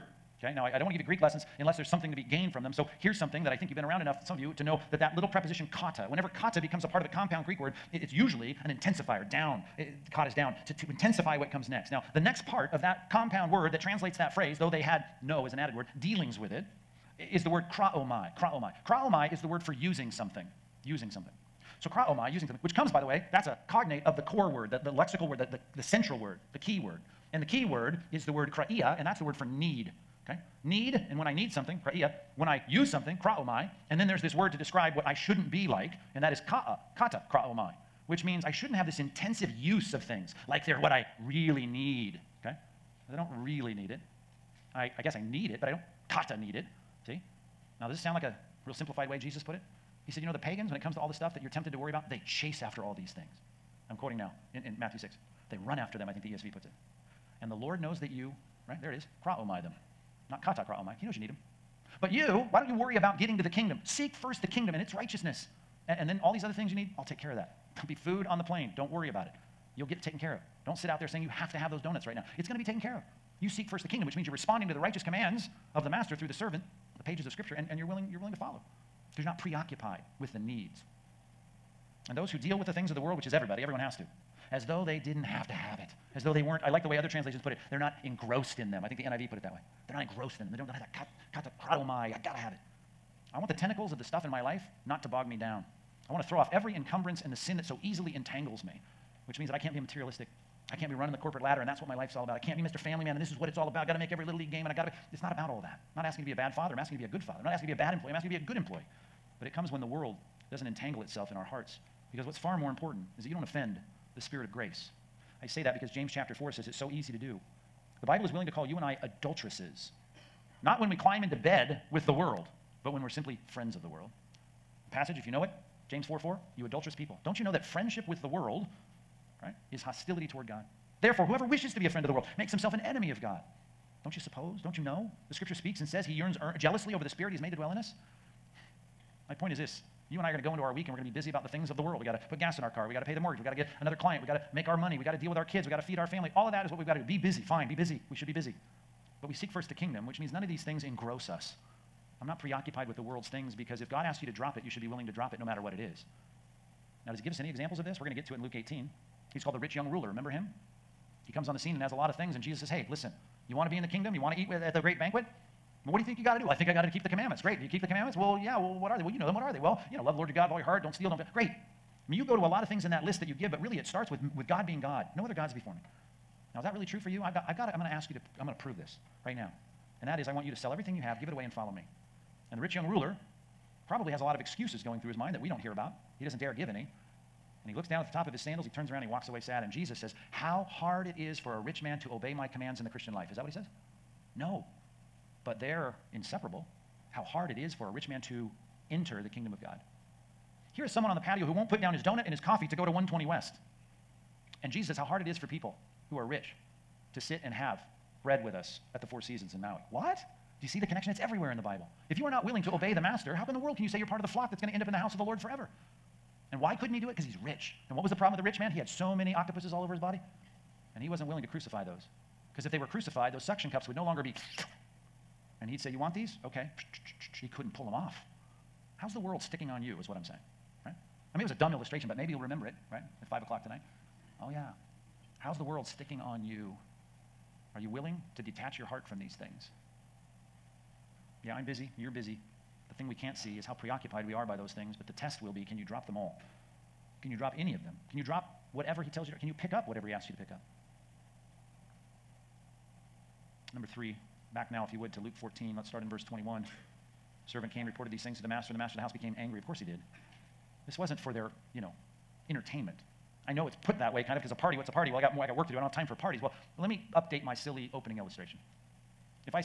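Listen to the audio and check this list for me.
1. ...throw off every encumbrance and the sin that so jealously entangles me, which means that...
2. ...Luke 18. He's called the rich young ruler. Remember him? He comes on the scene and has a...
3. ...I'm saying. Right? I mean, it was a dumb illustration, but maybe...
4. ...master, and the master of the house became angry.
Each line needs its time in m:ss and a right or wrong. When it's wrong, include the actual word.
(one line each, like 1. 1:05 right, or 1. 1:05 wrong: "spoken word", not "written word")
1. 1:36 wrong: "easily", not "jealously"
2. 2:38 right
3. 3:50 right
4. 4:18 right.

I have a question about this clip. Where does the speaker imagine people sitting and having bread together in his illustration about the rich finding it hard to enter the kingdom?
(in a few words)
Four Seasons in Maui.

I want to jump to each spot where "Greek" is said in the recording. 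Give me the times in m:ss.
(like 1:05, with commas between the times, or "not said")
0:01, 0:07.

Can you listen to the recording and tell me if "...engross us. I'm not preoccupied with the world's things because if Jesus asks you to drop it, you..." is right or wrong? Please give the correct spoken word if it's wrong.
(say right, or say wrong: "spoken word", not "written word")
wrong: "God", not "Jesus".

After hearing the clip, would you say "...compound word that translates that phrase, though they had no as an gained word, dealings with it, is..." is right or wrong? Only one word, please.
wrong.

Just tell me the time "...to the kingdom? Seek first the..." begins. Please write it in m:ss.
1:03.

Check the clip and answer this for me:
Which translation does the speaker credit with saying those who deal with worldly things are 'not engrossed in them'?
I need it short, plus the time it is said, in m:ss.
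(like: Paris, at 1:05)
NIV, at 1:29.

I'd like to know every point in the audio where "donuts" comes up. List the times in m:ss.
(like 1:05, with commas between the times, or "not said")
1:11, 3:22.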